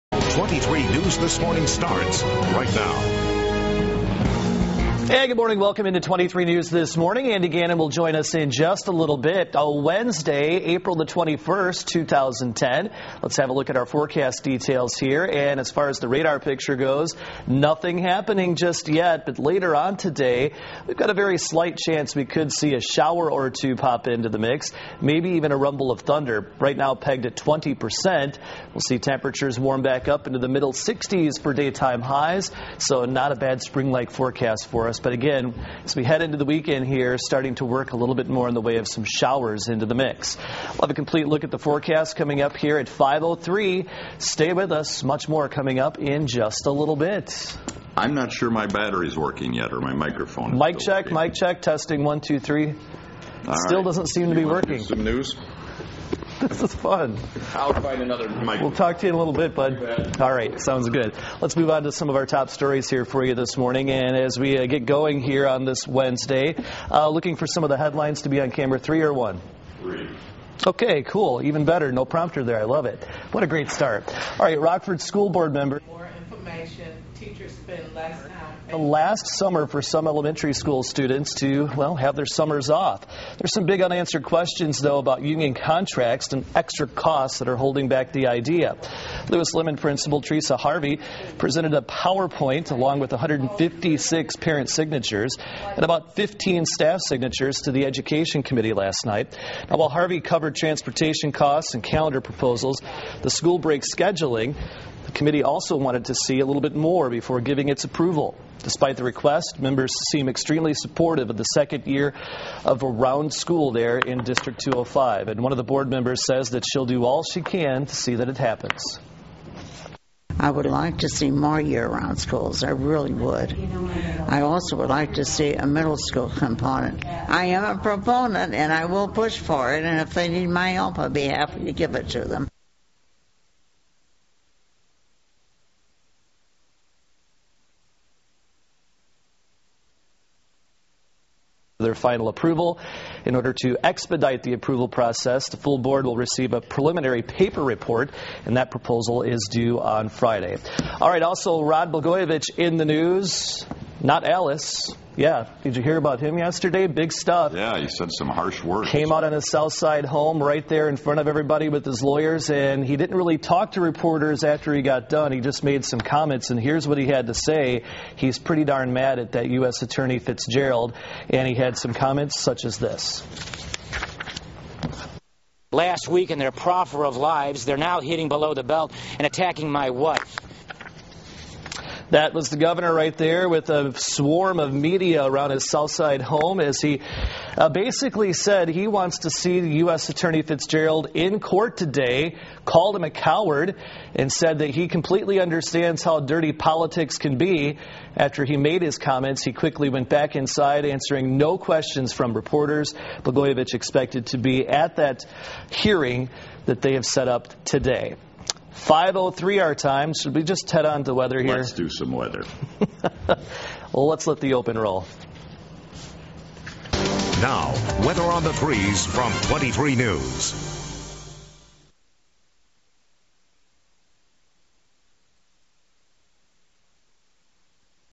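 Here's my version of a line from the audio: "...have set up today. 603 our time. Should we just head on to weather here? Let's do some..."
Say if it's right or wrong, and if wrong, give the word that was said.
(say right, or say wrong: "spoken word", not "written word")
wrong: "503", not "603".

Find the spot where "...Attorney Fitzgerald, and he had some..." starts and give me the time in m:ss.
2:49.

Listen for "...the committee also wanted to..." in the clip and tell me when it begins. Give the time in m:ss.
1:45.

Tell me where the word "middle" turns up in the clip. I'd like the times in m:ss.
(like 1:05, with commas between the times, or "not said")
0:30, 2:05.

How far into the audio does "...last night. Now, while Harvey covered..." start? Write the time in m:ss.
1:38.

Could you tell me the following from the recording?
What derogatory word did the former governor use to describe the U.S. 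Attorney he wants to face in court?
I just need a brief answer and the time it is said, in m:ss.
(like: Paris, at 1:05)
coward, at 3:13.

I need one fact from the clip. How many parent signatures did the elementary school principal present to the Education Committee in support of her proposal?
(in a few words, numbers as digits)
156.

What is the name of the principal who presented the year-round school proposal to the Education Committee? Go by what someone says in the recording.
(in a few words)
Teresa Harvey.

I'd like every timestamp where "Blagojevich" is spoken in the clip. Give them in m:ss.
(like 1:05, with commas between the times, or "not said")
2:31, 3:23.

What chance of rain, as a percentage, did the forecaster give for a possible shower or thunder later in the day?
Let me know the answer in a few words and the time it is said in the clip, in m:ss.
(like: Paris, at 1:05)
20%, at 0:27.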